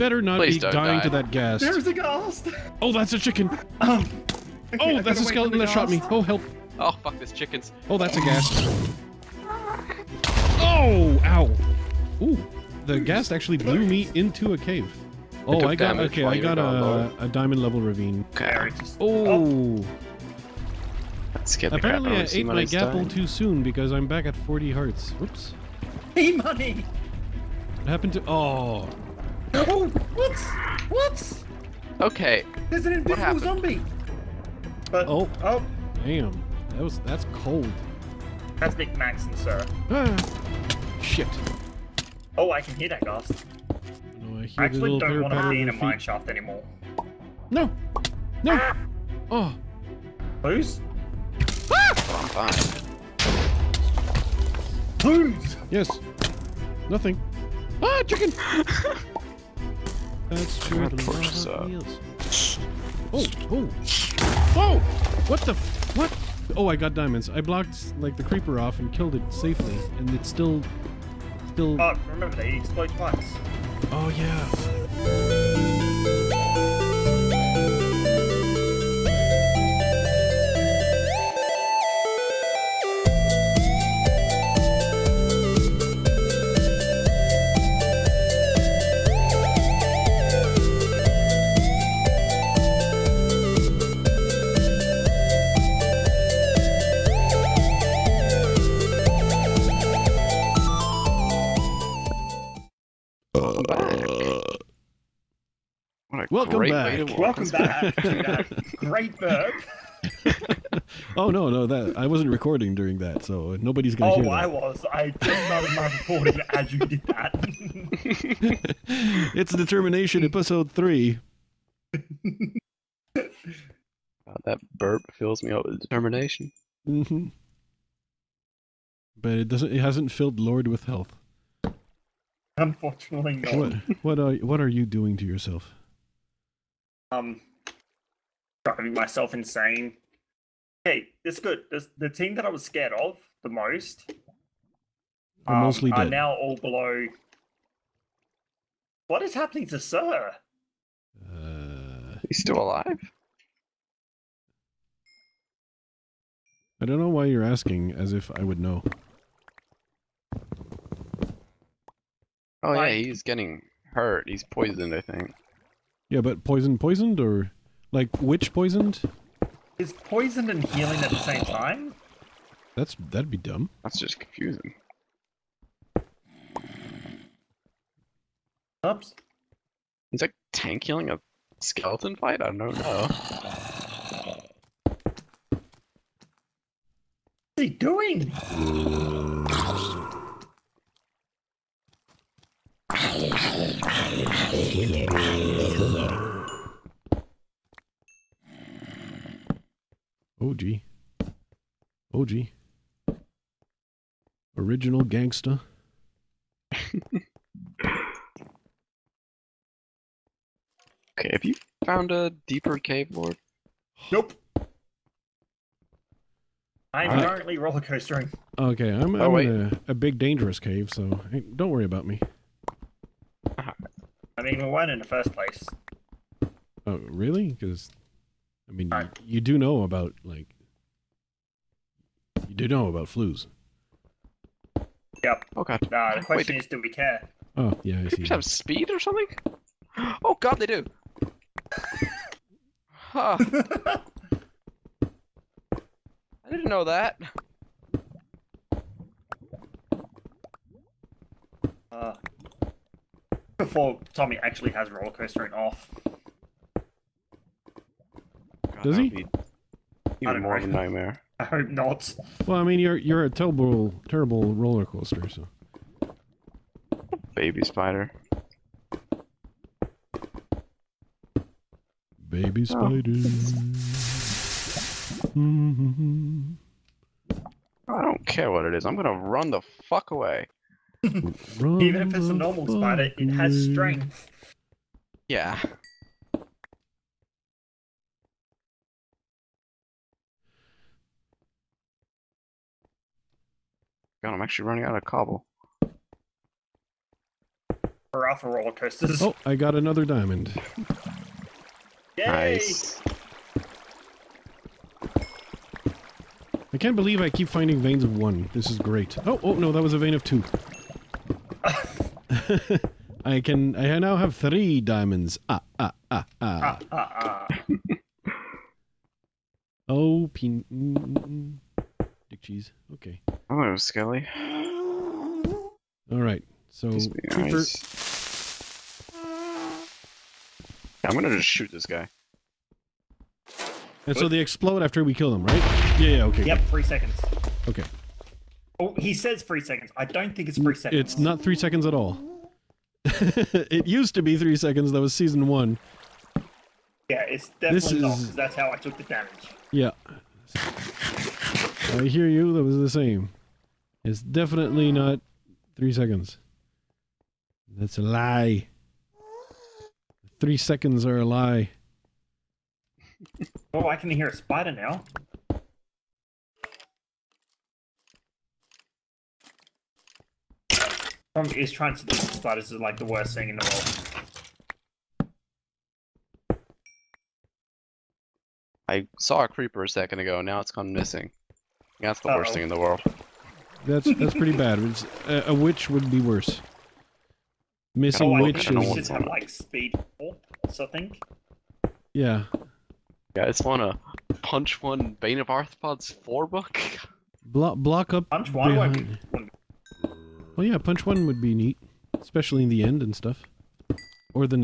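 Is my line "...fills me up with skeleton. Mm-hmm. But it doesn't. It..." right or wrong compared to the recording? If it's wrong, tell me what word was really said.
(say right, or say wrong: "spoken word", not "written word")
wrong: "determination", not "skeleton".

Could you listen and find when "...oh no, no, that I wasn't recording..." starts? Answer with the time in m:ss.
1:51.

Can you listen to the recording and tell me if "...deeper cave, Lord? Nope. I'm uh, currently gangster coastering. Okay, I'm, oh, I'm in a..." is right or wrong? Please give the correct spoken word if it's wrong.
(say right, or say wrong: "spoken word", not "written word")
wrong: "roller", not "gangster".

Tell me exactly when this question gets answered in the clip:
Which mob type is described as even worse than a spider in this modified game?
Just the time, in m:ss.
6:25.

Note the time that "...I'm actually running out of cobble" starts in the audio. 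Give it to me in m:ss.
4:54.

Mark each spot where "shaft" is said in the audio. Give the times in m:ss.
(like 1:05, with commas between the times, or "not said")
0:45.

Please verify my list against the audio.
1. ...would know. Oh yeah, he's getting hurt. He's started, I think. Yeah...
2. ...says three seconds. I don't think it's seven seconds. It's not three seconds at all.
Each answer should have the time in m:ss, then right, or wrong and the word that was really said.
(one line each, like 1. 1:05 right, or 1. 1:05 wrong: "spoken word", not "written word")
1. 2:38 wrong: "poisoned", not "started"
2. 5:39 wrong: "three", not "seven".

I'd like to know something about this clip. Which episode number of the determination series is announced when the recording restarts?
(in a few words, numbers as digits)
3.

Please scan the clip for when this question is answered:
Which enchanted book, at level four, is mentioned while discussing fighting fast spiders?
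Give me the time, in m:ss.
6:35.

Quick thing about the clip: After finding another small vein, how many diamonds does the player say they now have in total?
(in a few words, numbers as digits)
3.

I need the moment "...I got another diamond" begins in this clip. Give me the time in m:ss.
4:59.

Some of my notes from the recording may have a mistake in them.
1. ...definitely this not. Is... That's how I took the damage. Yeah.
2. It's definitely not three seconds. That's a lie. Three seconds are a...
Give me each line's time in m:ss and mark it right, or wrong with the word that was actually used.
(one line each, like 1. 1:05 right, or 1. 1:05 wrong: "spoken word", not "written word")
1. 5:47 right
2. 5:54 right.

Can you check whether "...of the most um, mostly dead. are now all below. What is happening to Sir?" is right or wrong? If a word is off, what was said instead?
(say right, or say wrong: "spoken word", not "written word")
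right.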